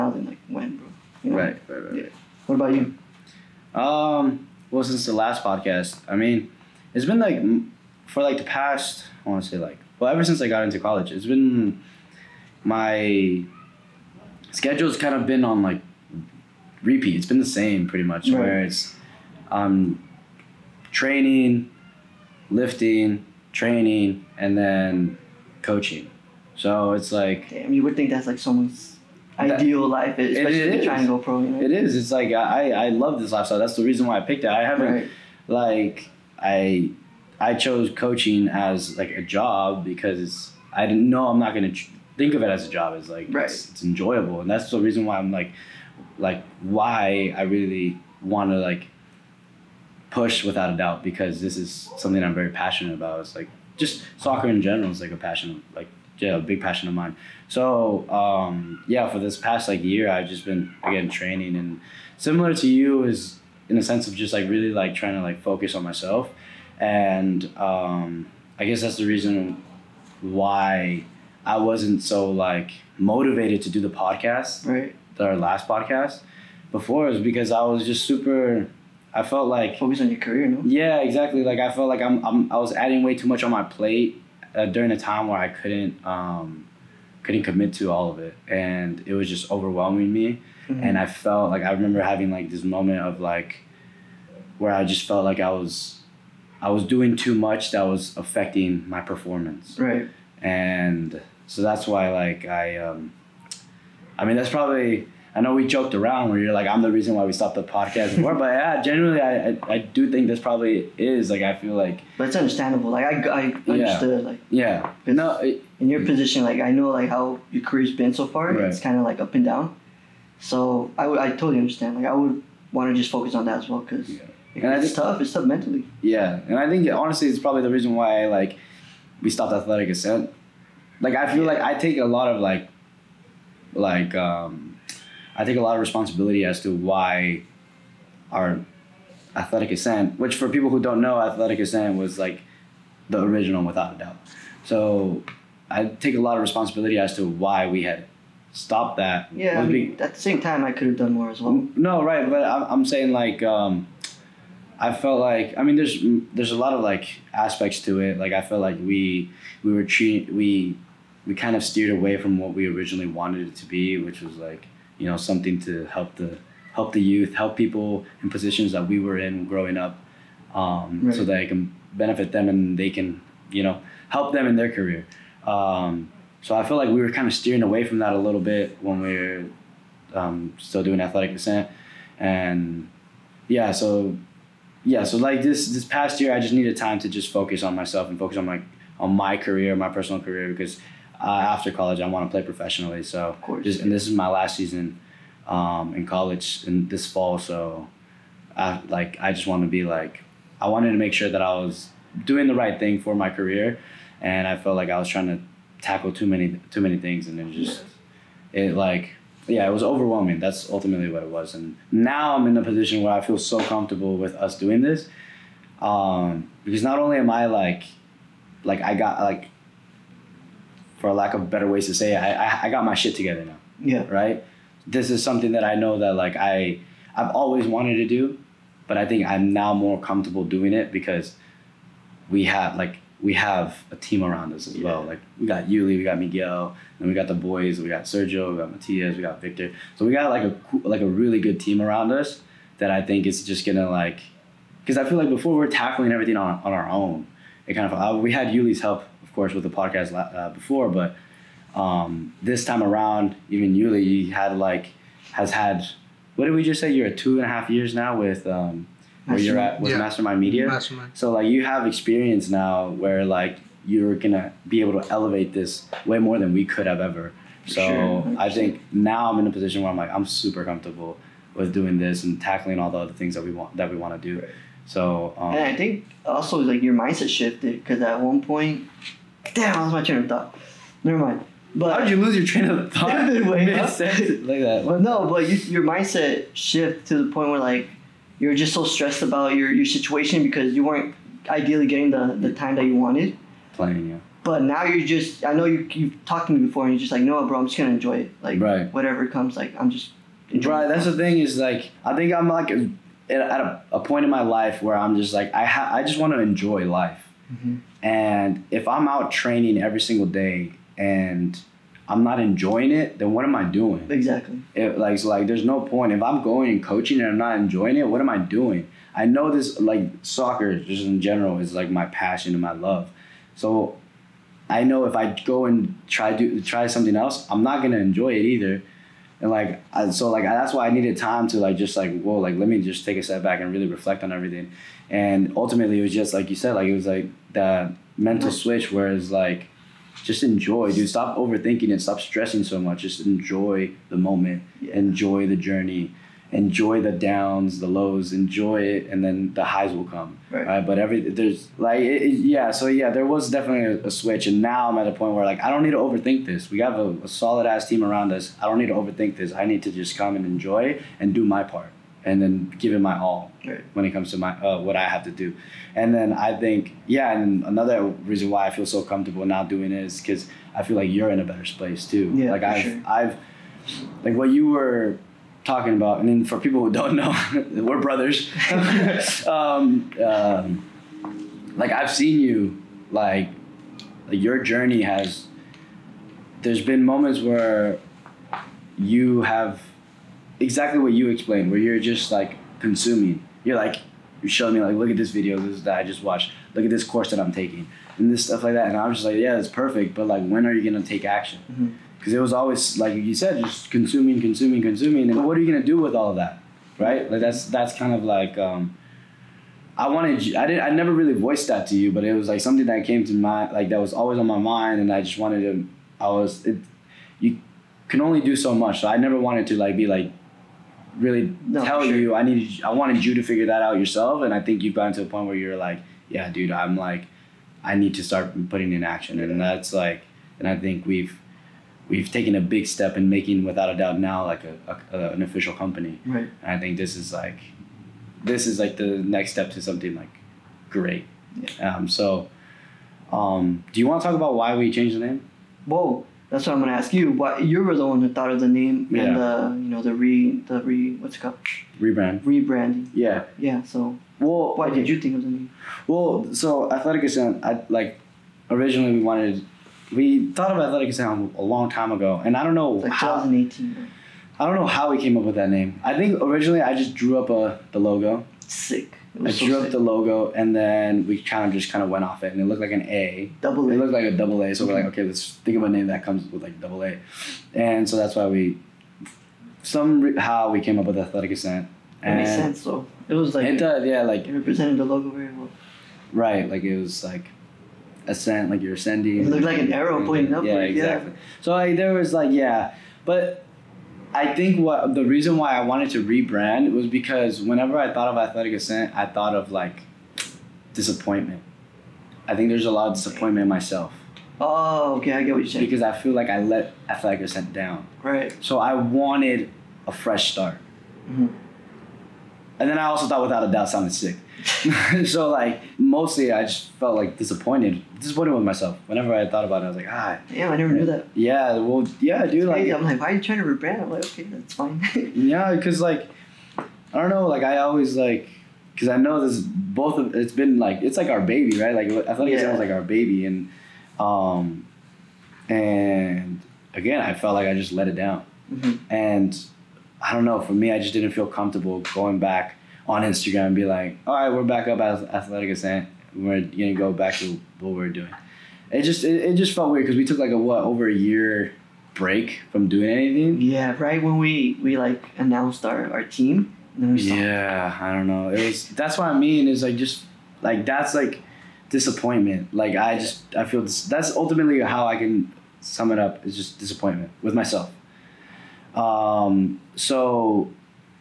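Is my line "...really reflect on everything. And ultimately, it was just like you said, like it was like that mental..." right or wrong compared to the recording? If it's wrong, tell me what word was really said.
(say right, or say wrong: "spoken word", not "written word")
right.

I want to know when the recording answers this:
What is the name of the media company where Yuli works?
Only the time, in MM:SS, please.
04:19.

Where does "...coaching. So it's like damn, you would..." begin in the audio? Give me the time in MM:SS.
00:25.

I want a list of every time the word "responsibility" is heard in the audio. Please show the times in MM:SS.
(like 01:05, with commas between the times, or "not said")
02:15, 02:26.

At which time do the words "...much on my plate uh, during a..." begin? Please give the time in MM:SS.
01:23.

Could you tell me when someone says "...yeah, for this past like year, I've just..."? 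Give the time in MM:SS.
00:58.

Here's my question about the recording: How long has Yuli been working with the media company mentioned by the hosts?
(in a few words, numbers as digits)
two and a half years.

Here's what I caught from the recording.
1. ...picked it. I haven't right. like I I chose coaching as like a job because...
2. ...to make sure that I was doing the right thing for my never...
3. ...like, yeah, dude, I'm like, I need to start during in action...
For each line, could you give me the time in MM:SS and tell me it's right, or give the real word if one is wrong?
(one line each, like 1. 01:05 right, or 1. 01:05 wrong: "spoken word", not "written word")
1. 00:34 right
2. 03:20 wrong: "career", not "never"
3. 07:05 wrong: "putting", not "during".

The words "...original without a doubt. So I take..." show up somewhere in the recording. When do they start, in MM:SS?
02:23.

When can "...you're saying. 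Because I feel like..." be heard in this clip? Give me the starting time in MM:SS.
08:25.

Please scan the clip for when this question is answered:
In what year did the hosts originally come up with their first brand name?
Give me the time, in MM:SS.
07:43.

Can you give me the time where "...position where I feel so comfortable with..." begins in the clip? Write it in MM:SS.
03:32.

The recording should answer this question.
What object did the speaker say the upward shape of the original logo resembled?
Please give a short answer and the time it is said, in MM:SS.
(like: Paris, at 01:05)
an arrow, at 08:09.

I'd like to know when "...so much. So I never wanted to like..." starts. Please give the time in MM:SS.
06:58.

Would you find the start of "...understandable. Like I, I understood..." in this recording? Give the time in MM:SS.
01:52.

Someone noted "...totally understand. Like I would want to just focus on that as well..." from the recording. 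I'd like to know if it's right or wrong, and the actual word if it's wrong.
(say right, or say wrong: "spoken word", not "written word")
right.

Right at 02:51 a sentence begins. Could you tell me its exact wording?
so that I can benefit them and they can you know help them in their career.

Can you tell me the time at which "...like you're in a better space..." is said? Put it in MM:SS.
06:10.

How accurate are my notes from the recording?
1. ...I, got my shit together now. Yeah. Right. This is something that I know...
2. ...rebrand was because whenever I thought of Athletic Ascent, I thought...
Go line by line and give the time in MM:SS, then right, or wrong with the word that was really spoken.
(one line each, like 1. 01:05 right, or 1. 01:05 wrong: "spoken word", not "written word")
1. 03:42 right
2. 08:16 right.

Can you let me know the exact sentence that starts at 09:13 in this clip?
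Yeah, right when we we like announced our our team.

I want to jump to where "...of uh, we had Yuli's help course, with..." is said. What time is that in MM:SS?
04:07.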